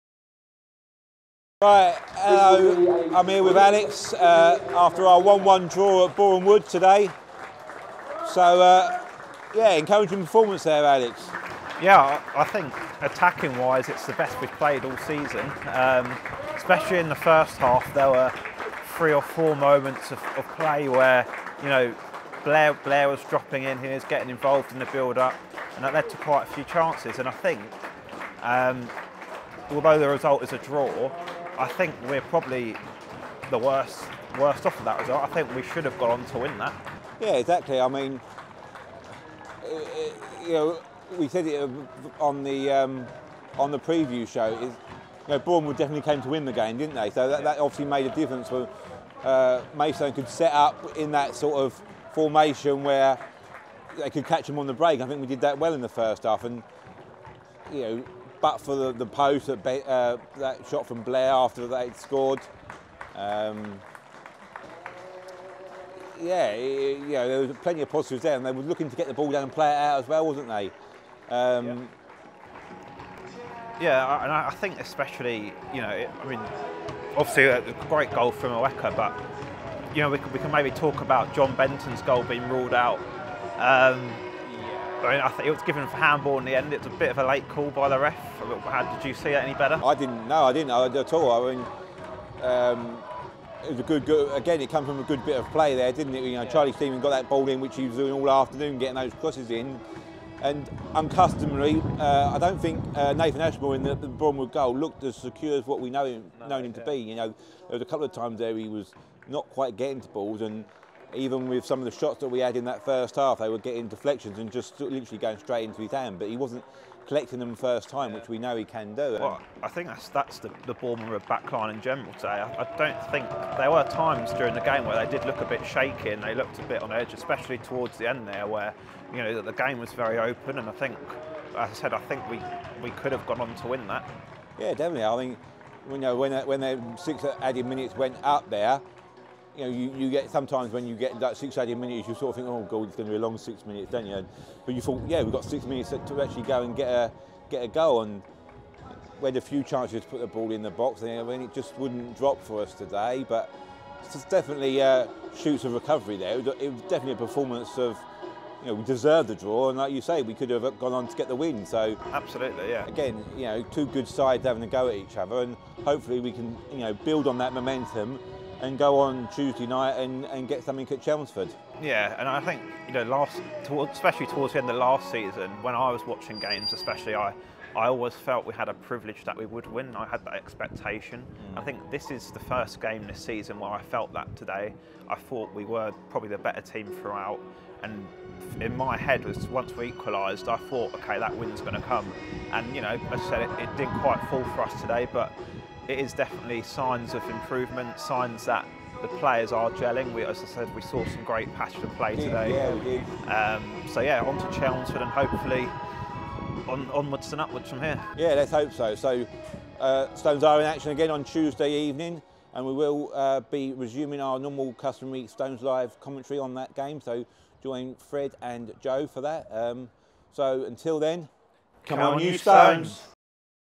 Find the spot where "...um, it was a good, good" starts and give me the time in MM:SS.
01:32.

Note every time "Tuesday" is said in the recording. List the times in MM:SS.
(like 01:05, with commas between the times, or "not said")
02:49, 03:31.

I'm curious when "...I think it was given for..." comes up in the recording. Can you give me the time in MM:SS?
01:25.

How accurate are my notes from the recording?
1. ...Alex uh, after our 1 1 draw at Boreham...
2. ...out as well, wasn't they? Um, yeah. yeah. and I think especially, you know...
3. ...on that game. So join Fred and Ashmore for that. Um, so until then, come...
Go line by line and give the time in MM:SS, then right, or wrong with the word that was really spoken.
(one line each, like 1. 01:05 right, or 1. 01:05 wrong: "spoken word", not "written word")
1. 00:03 right
2. 01:09 right
3. 03:36 wrong: "Joe", not "Ashmore".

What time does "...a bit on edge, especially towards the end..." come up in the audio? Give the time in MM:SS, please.
02:06.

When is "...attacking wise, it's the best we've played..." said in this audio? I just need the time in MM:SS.
00:13.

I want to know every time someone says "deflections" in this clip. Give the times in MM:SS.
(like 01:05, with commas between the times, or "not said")
01:53.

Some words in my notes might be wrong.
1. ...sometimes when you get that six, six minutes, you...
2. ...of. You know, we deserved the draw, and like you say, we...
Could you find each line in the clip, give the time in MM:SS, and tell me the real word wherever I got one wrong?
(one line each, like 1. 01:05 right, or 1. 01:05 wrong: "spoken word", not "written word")
1. 02:20 wrong: "eight", not "six"
2. 02:37 right.